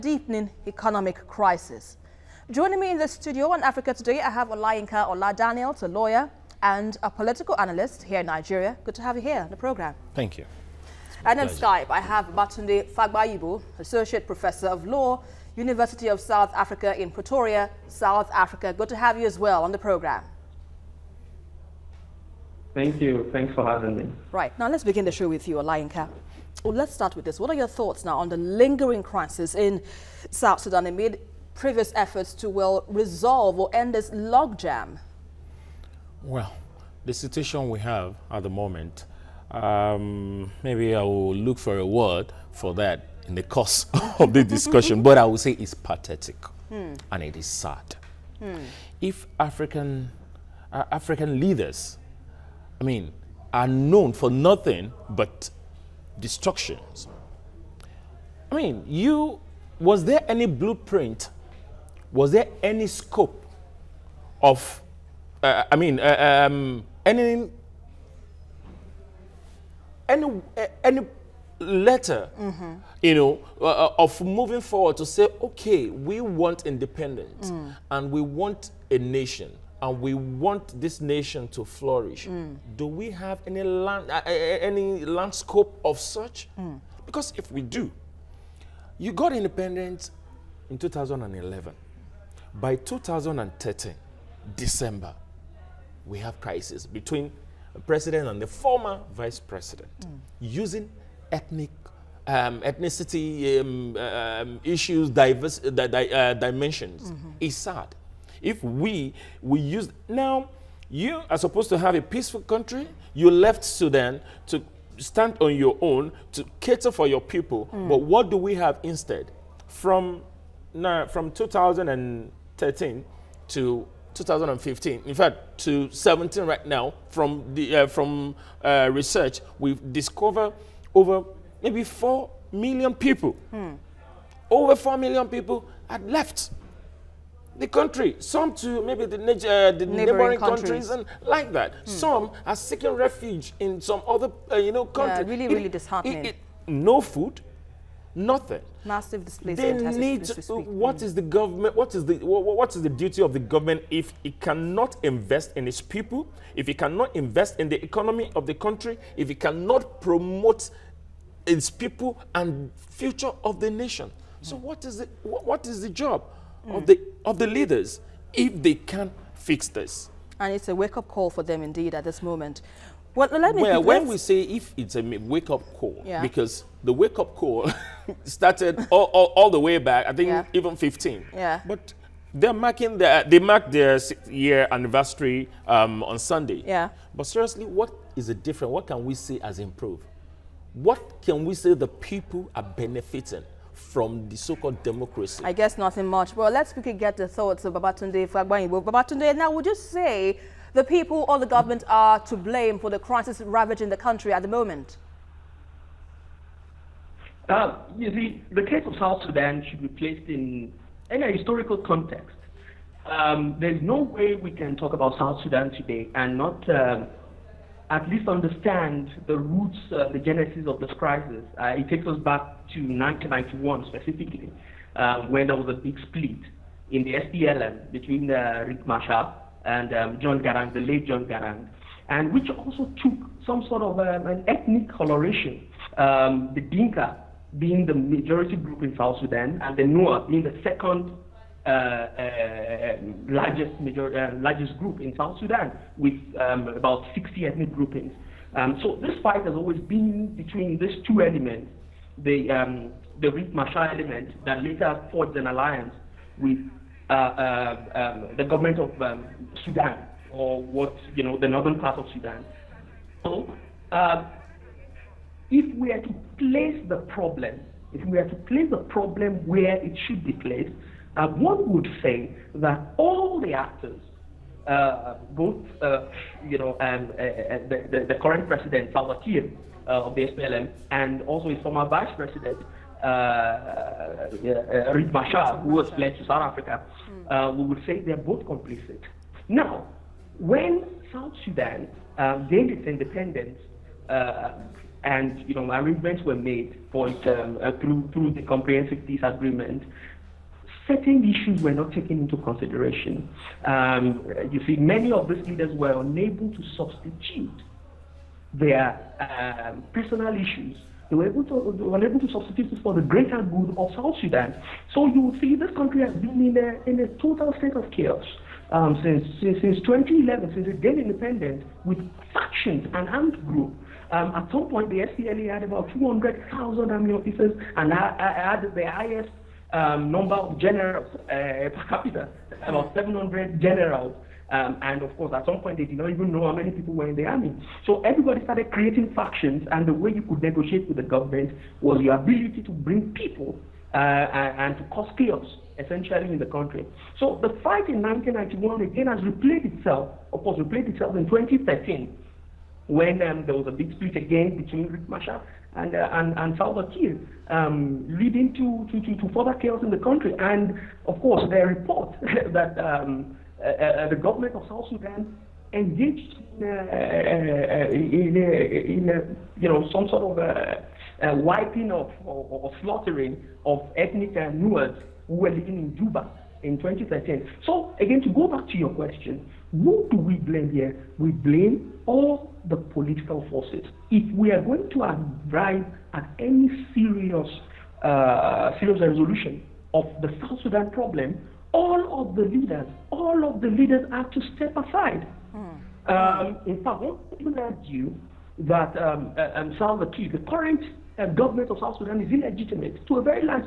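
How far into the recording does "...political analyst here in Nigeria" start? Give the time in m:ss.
0:07.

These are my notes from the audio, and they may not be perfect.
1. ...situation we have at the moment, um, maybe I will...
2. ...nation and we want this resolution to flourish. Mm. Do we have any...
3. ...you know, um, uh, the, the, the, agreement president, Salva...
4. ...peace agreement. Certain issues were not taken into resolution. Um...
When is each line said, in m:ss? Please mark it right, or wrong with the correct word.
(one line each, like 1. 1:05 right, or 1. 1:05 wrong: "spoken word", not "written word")
1. 0:37 right
2. 1:18 wrong: "nation", not "resolution"
3. 4:36 wrong: "current", not "agreement"
4. 4:59 wrong: "consideration", not "resolution".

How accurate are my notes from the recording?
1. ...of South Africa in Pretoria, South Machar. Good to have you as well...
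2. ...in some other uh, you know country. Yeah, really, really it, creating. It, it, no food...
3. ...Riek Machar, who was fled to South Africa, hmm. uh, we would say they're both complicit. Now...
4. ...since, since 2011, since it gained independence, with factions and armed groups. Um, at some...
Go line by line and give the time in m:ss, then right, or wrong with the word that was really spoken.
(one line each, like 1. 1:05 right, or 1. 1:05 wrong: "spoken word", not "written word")
1. 0:16 wrong: "Africa", not "Machar"
2. 2:23 wrong: "disheartening", not "creating"
3. 4:44 right
4. 5:19 right.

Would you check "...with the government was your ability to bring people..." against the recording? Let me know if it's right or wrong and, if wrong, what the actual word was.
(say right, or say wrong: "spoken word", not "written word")
right.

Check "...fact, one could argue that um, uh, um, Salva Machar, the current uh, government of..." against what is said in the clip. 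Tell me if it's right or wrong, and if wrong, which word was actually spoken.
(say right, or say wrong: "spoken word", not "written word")
wrong: "Kiir", not "Machar".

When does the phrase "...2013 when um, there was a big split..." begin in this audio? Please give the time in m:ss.
5:51.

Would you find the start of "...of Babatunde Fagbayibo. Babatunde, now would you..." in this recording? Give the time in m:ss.
3:17.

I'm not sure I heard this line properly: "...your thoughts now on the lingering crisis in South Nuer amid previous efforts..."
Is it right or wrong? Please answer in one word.
wrong.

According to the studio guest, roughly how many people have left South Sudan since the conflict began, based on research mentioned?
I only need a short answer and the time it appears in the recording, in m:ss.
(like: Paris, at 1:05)
over 4 million, at 2:14.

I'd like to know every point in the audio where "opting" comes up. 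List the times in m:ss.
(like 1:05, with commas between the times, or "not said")
not said.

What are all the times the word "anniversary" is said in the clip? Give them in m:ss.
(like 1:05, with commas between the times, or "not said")
3:04.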